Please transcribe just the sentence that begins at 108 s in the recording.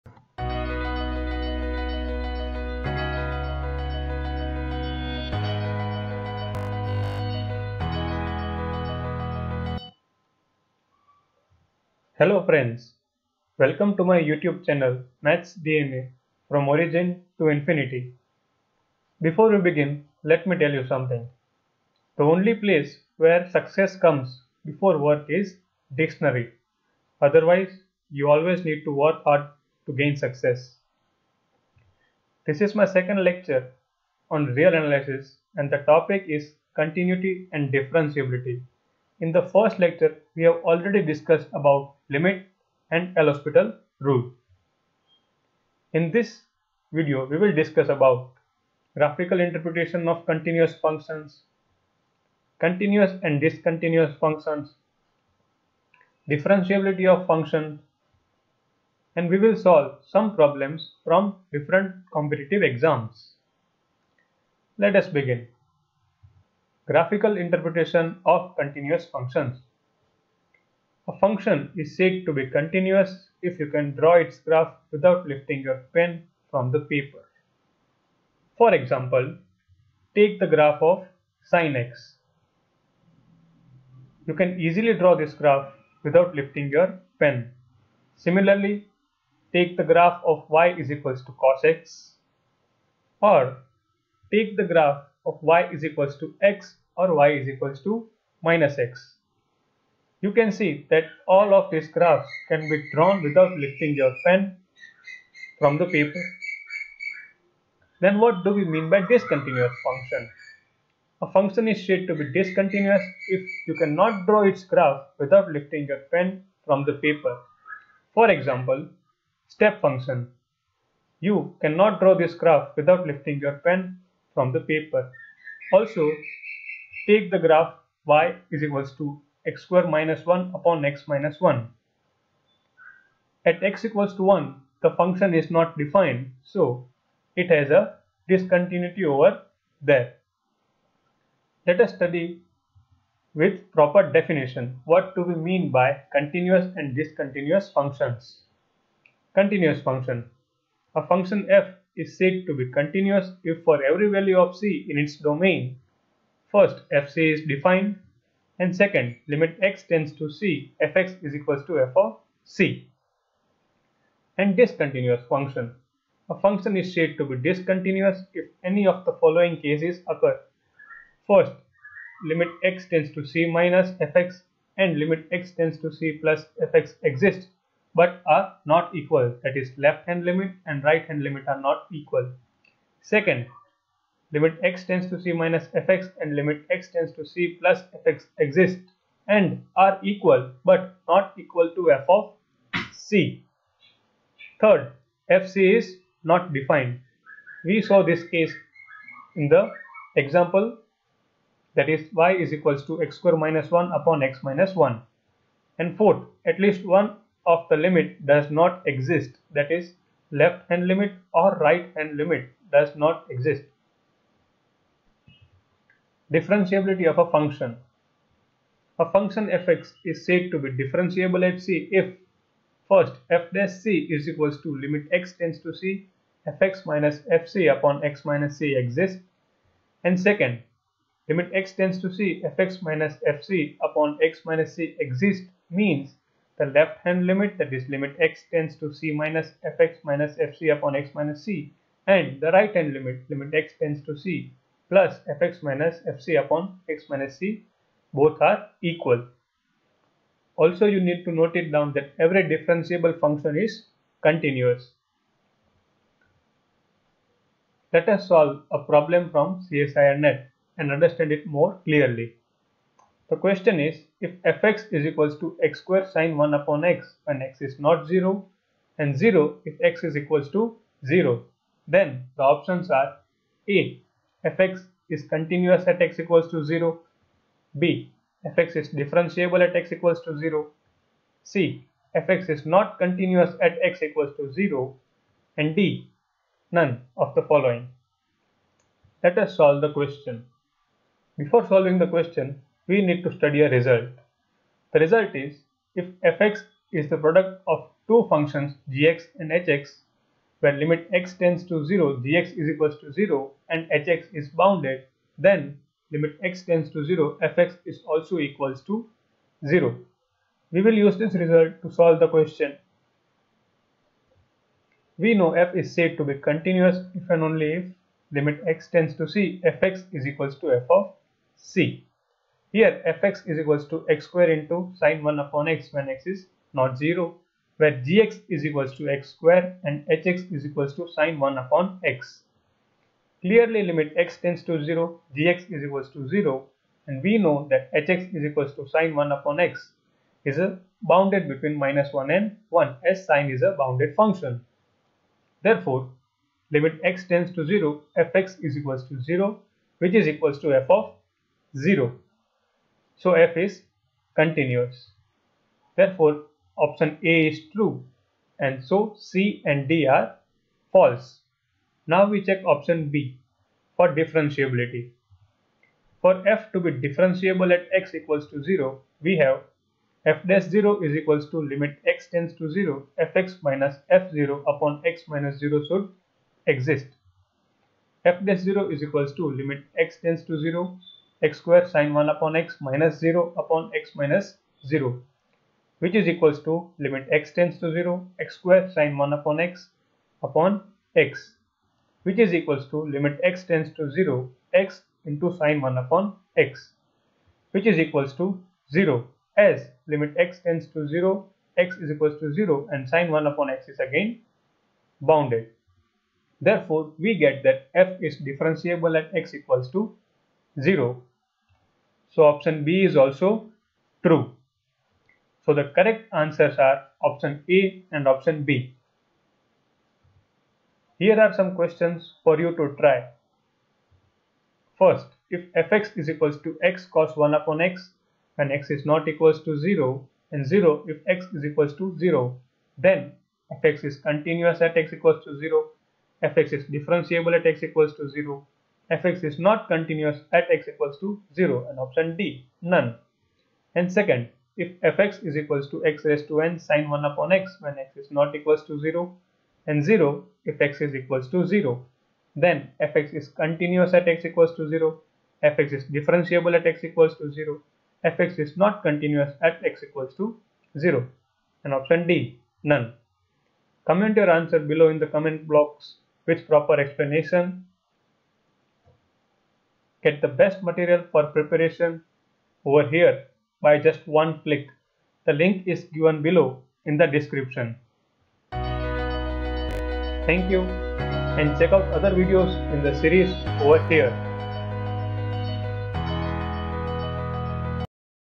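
Then what do we mean by discontinuous function?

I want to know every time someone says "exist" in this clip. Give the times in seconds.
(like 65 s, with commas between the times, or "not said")
177 s, 188 s, 208 s, 213 s, 228 s, 234 s, 376 s.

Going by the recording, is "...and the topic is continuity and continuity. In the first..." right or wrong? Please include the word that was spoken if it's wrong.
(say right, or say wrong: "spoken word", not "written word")
wrong: "differentiability", not "continuity".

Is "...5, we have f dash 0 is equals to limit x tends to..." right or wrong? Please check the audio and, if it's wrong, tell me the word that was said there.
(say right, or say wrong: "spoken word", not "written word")
wrong: "0", not "5".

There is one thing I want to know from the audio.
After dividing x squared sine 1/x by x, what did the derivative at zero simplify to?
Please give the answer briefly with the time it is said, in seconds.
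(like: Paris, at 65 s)
x sine 1/x, at 394 s.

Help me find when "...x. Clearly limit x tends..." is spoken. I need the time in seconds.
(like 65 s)
332 s.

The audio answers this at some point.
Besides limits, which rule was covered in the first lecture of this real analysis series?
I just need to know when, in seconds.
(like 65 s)
43 s.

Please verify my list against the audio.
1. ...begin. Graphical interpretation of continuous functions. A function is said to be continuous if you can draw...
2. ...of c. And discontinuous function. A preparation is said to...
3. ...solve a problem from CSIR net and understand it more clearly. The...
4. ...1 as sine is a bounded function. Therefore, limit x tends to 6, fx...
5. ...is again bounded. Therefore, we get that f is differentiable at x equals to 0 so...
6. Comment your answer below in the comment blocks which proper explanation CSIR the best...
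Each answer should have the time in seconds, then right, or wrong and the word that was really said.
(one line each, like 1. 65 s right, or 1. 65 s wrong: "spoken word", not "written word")
1. 65 s right
2. 161 s wrong: "function", not "preparation"
3. 258 s right
4. 342 s wrong: "0", not "6"
5. 403 s right
6. 464 s wrong: "Get", not "CSIR".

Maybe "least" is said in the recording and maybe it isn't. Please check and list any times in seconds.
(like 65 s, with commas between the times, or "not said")
206 s.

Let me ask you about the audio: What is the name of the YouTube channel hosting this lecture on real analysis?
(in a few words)
Maths DNA.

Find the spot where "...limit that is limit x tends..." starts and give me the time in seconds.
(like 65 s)
237 s.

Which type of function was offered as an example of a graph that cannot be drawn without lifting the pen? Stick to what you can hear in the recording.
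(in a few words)
step function.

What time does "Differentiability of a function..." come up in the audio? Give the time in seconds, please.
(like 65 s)
216 s.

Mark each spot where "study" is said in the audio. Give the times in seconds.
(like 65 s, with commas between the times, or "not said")
141 s, 293 s.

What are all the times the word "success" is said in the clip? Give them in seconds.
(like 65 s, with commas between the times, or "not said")
23 s, 30 s.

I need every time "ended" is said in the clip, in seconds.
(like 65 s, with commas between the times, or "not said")
not said.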